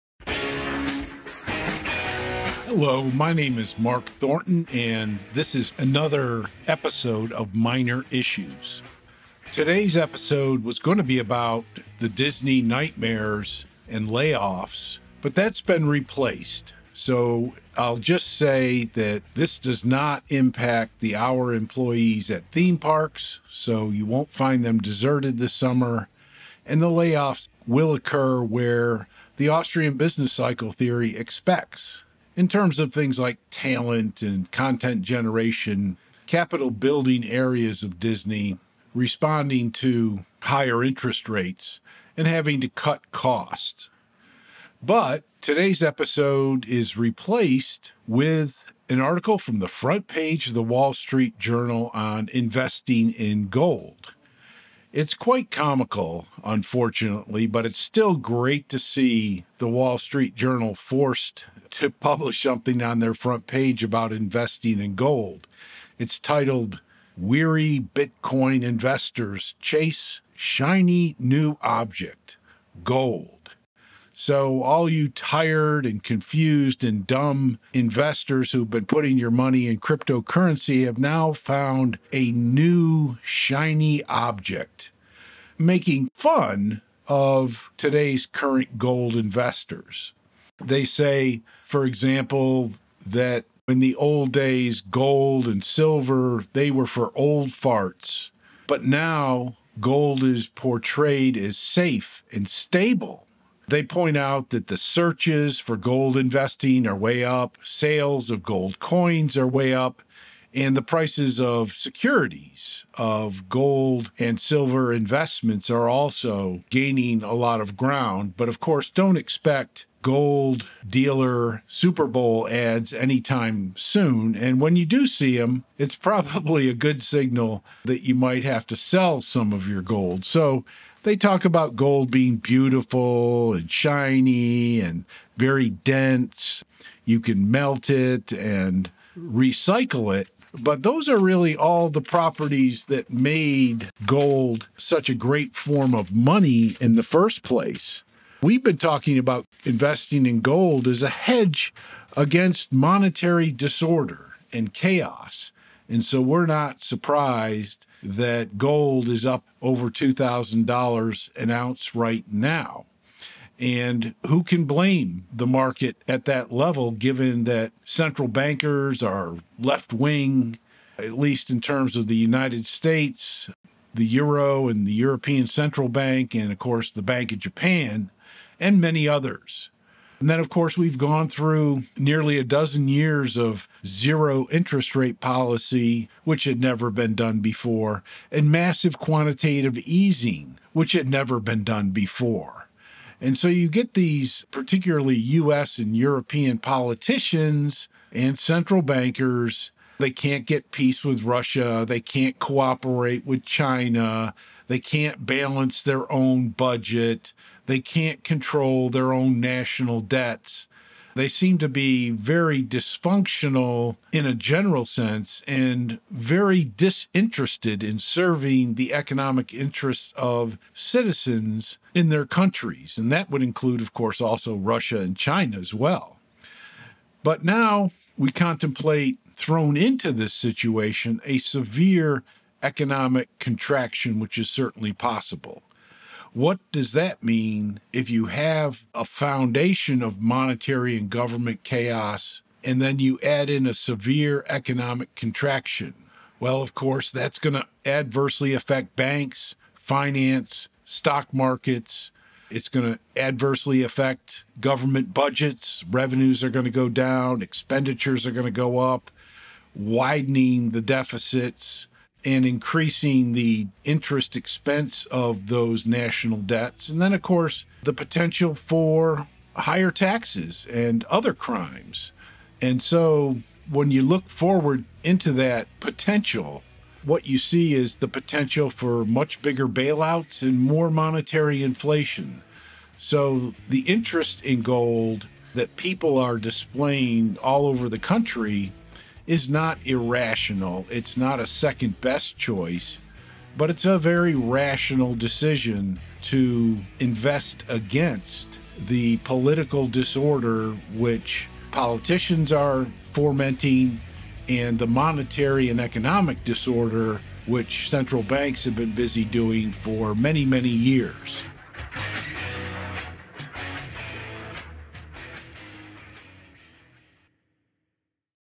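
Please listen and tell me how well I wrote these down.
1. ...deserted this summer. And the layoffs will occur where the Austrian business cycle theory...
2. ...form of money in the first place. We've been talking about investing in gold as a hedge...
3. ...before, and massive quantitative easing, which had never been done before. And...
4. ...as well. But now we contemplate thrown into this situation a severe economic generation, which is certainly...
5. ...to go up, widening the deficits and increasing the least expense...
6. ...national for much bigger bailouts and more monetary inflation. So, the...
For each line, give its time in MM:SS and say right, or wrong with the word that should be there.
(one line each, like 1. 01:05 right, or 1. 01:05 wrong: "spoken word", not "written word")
1. 00:24 right
2. 02:25 right
3. 03:07 right
4. 03:45 wrong: "contraction", not "generation"
5. 04:18 wrong: "interest", not "least"
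6. 04:38 wrong: "potential", not "national".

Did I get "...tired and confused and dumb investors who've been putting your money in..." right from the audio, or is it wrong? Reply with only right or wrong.
right.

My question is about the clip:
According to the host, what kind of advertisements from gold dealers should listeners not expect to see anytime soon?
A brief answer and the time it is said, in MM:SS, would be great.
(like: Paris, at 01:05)
Super Bowl ads, at 02:01.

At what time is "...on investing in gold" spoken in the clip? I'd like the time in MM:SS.
00:51.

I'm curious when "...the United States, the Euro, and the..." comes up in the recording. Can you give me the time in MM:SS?
02:52.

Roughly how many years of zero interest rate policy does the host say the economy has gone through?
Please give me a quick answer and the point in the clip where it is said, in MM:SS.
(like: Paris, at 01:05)
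nearly a dozen, at 03:01.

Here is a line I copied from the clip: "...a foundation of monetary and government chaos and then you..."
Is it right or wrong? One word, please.
right.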